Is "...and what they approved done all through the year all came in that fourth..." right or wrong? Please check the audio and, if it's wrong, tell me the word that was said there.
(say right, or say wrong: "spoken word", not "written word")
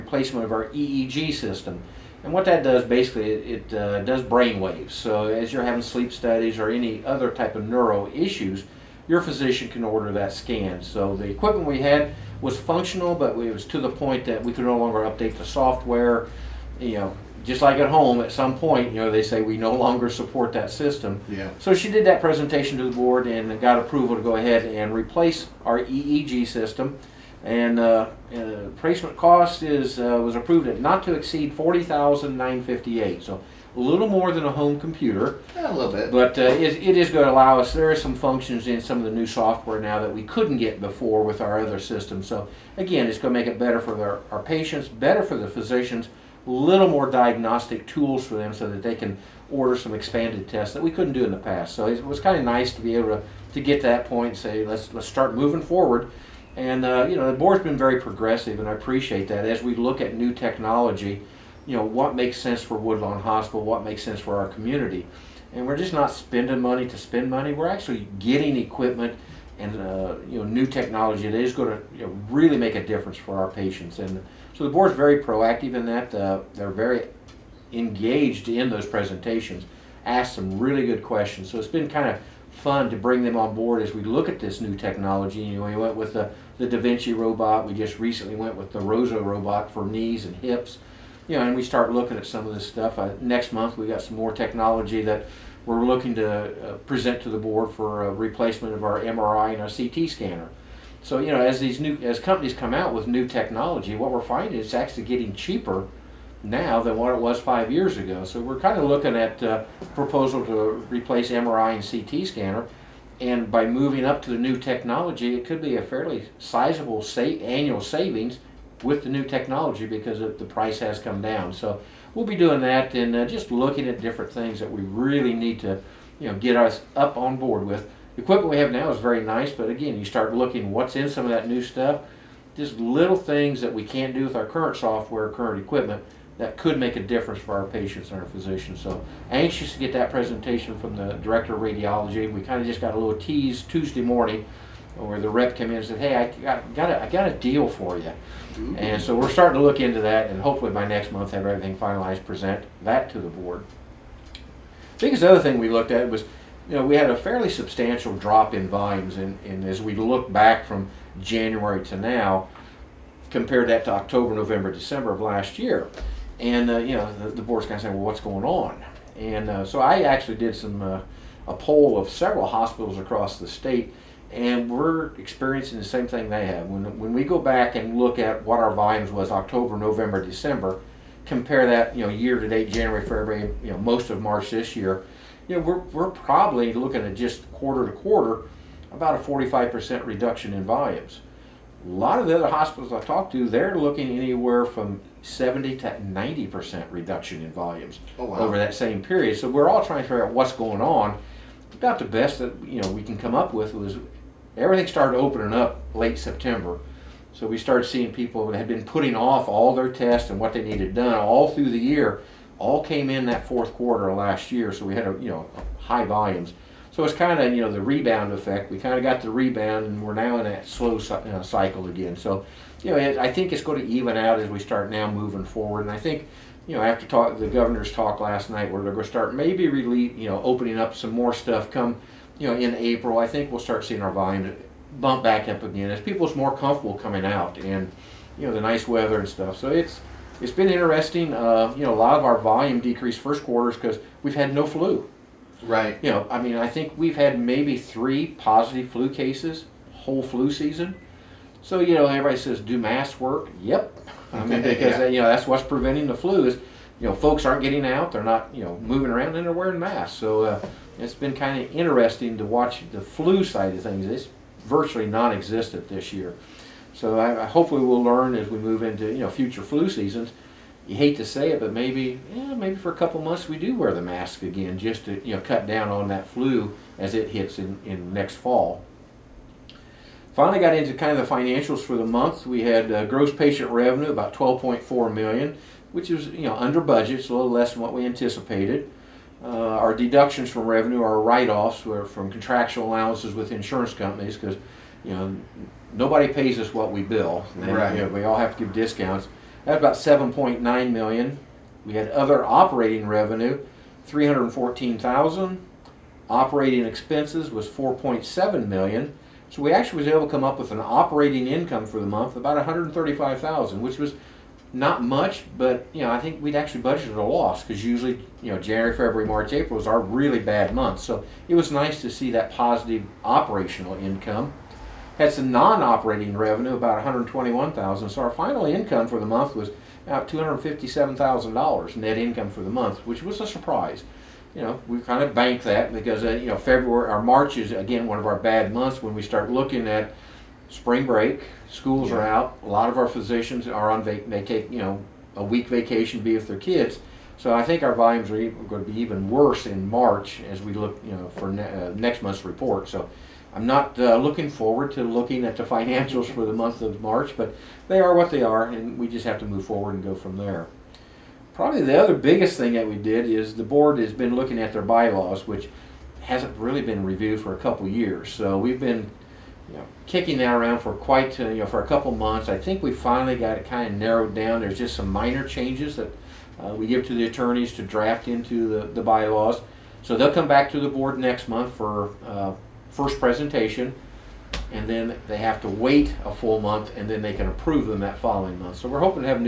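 wrong: "needed", not "approved".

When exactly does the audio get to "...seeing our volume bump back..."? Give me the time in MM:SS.
03:53.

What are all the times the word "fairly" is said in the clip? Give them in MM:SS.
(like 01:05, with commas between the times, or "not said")
01:55, 02:37.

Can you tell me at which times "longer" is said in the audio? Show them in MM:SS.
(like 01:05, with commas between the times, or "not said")
00:14, 00:19.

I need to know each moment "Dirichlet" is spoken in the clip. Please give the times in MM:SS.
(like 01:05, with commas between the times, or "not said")
not said.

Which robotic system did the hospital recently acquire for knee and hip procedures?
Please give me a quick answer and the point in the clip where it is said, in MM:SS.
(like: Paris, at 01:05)
Rosa robot, at 01:28.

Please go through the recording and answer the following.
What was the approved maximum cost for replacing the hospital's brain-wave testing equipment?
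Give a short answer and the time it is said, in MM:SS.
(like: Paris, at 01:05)
$40,958, at 00:31.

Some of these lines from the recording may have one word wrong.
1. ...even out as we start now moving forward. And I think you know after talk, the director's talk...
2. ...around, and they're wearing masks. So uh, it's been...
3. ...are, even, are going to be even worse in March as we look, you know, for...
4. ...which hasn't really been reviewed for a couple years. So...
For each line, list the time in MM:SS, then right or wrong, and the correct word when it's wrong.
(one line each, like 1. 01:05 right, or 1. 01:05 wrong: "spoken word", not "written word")
1. 03:43 wrong: "governor", not "director"
2. 04:19 right
3. 05:48 right
4. 06:05 right.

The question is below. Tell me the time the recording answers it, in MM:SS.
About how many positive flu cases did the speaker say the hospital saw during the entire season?
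04:07.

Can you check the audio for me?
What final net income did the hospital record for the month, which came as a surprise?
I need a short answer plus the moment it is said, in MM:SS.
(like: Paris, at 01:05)
$257,000, at 05:30.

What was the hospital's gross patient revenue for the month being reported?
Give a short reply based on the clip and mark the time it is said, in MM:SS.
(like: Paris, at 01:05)
12.4 million, at 04:44.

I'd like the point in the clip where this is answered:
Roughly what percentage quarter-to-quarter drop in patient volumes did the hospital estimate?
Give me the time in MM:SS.
03:09.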